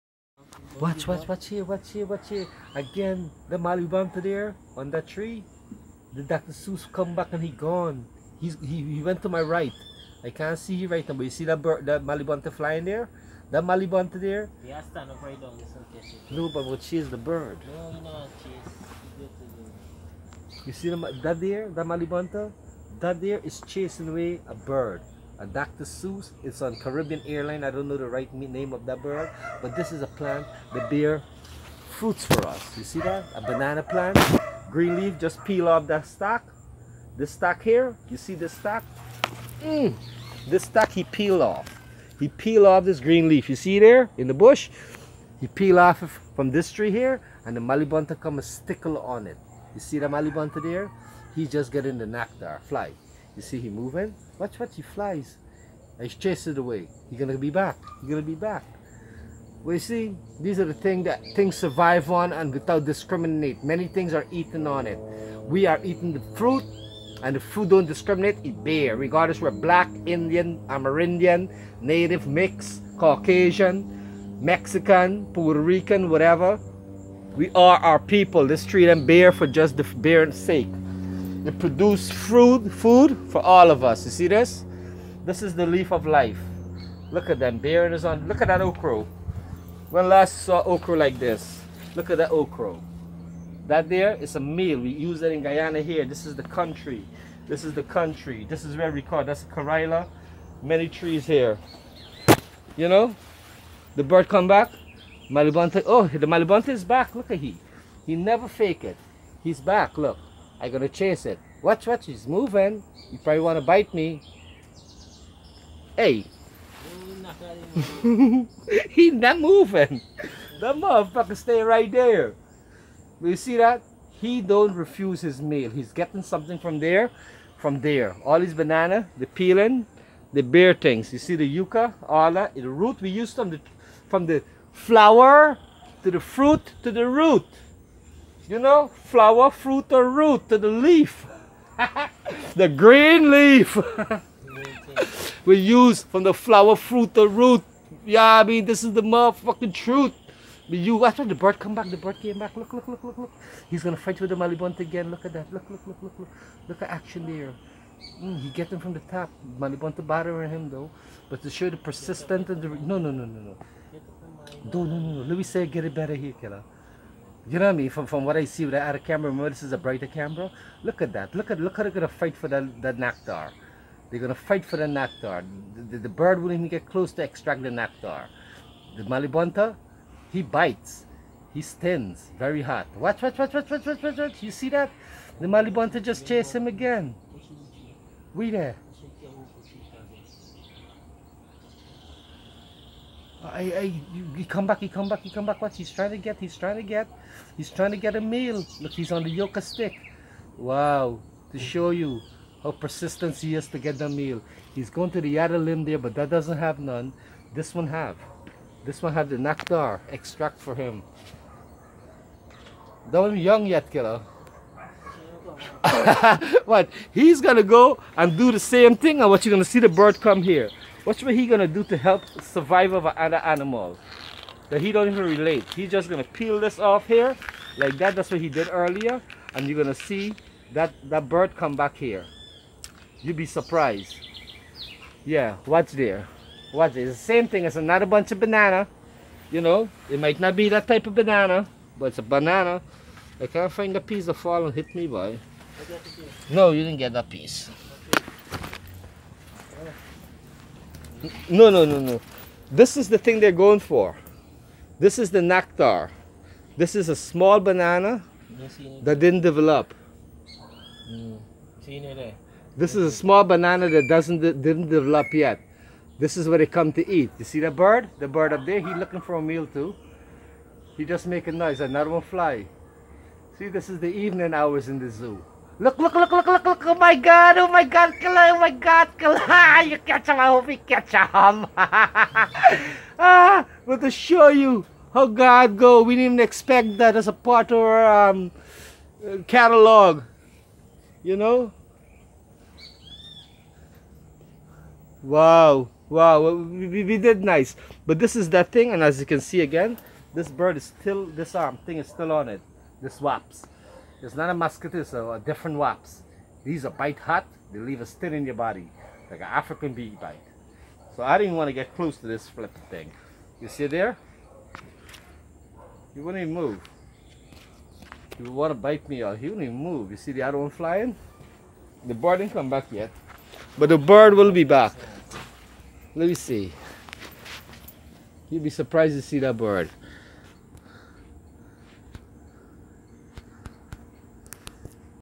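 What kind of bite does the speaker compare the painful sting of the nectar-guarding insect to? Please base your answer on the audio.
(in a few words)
African bee.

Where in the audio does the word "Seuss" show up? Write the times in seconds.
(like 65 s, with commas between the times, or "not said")
6 s, 25 s.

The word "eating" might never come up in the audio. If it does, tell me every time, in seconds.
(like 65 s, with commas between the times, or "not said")
65 s.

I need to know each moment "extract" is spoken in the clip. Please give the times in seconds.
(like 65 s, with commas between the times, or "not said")
177 s, 210 s.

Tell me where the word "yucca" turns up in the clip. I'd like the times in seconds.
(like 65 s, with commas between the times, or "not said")
131 s, 199 s.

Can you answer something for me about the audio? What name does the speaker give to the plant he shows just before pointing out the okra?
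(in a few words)
leaf of life.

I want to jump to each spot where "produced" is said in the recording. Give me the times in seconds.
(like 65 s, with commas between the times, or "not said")
81 s.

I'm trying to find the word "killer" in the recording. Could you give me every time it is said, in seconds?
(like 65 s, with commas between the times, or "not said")
166 s, 213 s.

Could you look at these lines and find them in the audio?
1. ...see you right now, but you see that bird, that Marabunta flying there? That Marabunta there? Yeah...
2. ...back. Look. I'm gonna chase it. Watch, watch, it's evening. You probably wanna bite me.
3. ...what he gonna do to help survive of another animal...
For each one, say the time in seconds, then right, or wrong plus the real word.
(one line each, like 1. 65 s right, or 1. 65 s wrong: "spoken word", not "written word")
1. 10 s right
2. 109 s wrong: "moving", not "evening"
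3. 221 s right.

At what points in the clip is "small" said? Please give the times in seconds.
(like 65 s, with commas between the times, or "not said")
257 s, 263 s.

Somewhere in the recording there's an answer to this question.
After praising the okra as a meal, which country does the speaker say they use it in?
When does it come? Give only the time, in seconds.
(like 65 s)
95 s.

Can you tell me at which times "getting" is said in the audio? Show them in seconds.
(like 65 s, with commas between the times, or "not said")
51 s, 125 s.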